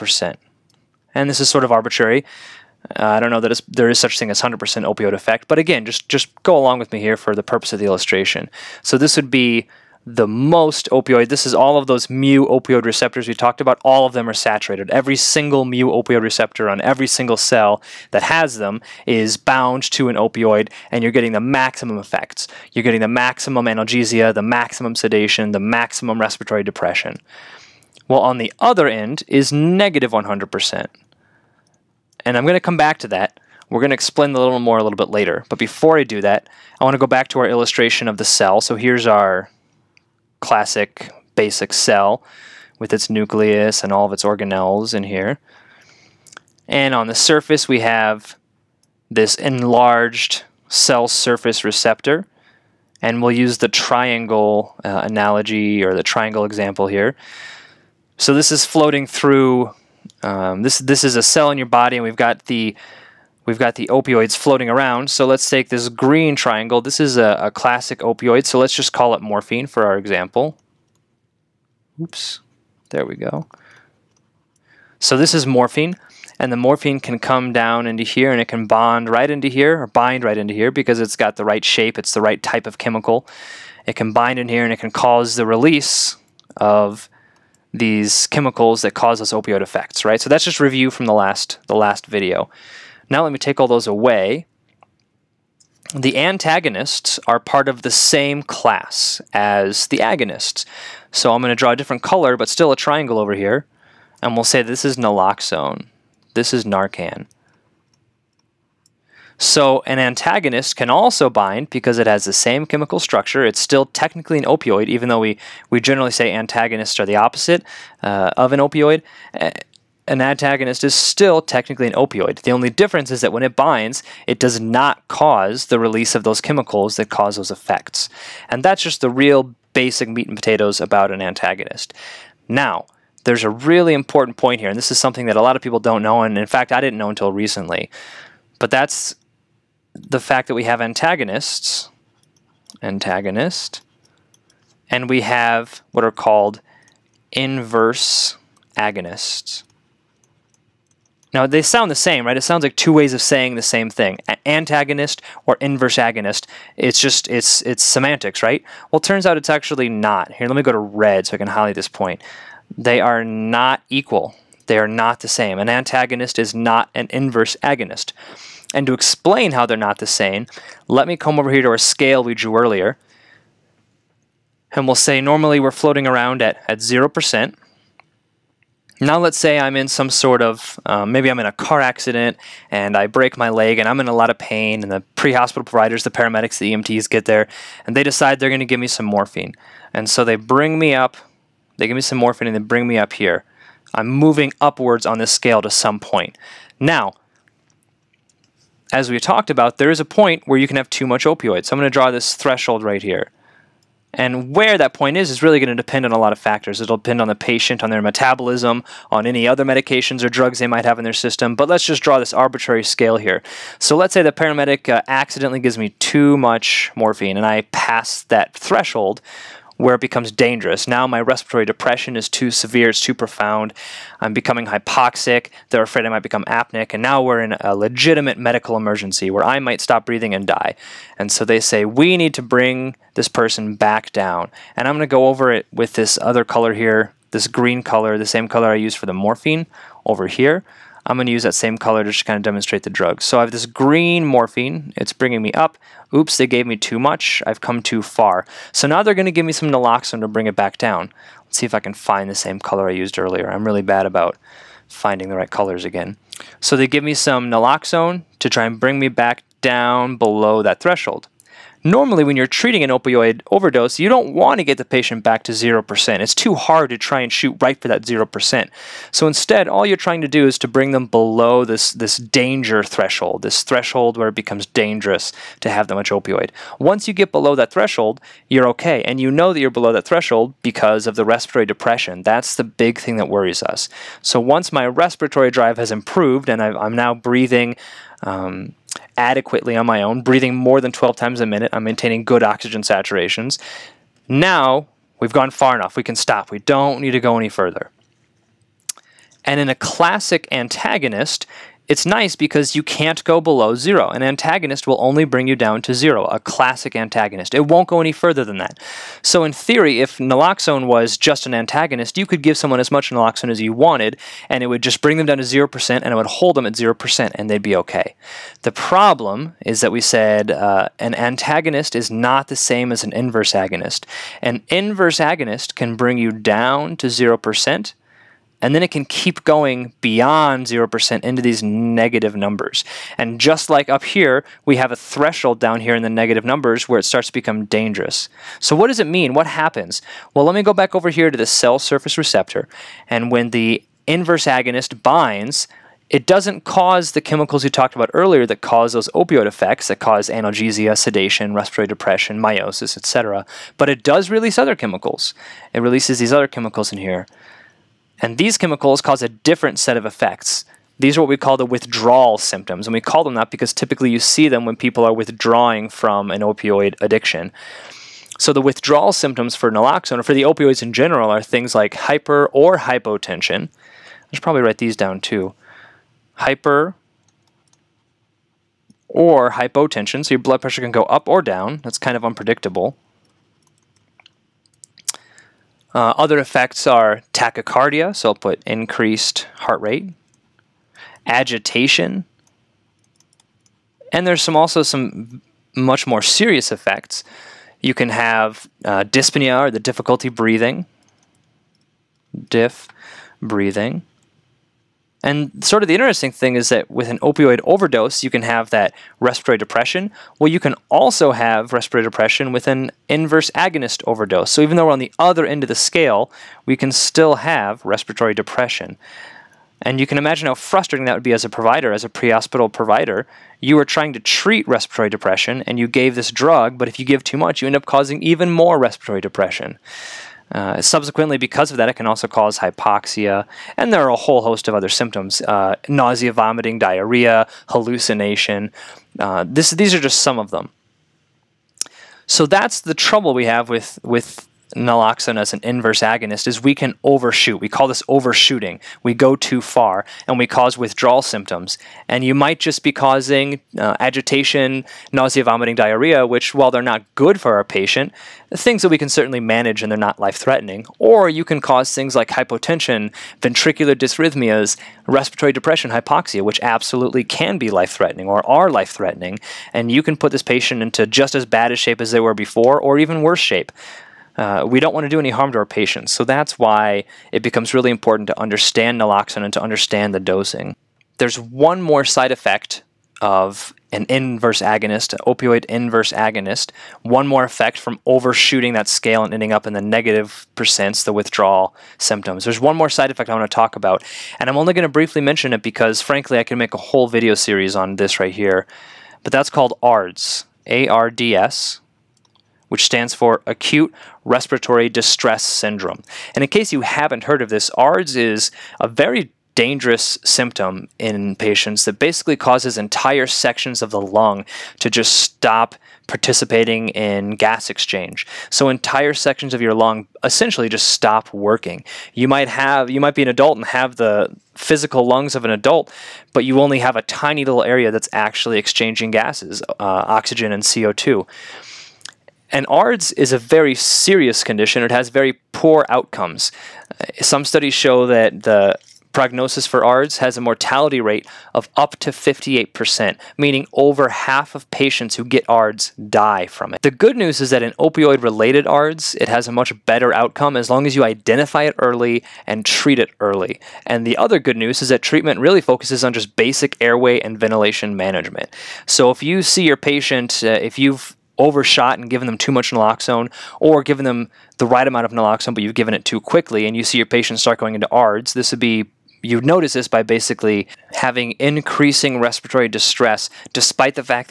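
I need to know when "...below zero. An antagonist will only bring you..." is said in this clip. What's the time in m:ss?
5:03.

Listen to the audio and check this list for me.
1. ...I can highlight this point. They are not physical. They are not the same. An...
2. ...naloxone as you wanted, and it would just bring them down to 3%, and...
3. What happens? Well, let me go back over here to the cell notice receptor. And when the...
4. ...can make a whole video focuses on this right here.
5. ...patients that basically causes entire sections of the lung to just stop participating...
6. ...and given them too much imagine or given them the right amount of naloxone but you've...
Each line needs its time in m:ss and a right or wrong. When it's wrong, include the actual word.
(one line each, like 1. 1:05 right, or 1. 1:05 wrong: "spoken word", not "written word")
1. 2:41 wrong: "equal", not "physical"
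2. 5:13 wrong: "0", not "3"
3. 5:39 wrong: "surface", not "notice"
4. 8:16 wrong: "series", not "focuses"
5. 8:31 right
6. 9:21 wrong: "naloxone", not "imagine".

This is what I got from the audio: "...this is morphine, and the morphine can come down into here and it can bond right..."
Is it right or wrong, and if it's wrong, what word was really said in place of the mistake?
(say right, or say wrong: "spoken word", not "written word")
right.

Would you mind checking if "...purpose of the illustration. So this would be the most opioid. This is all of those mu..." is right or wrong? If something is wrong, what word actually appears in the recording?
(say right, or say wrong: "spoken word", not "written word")
right.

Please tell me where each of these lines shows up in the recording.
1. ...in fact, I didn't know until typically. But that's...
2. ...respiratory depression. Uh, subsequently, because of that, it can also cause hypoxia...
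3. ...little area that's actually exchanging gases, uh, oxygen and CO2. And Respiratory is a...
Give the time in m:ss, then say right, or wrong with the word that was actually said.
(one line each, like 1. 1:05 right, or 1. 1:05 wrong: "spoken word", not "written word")
1. 2:16 wrong: "recently", not "typically"
2. 7:08 right
3. 8:47 wrong: "ARDS", not "Respiratory".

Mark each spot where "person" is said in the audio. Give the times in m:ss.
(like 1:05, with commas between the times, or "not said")
3:53.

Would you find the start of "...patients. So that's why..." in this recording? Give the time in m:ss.
7:55.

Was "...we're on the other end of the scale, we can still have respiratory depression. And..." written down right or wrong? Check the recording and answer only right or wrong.
right.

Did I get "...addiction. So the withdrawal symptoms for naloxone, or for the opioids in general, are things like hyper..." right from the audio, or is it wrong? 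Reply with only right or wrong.
right.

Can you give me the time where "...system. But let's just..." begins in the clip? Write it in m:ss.
3:31.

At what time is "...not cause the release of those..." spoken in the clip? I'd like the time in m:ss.
2:04.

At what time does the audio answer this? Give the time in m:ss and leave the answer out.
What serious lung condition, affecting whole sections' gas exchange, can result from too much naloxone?
8:23.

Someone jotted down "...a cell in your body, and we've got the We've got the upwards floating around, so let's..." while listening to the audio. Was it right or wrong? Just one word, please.
wrong.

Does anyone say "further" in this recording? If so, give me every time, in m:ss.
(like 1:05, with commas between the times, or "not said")
4:57, 5:08.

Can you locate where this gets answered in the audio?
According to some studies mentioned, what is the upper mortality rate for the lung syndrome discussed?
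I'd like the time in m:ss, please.
9:02.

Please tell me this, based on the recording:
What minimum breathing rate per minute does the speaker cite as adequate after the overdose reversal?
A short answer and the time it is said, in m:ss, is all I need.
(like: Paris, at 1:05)
12, at 4:50.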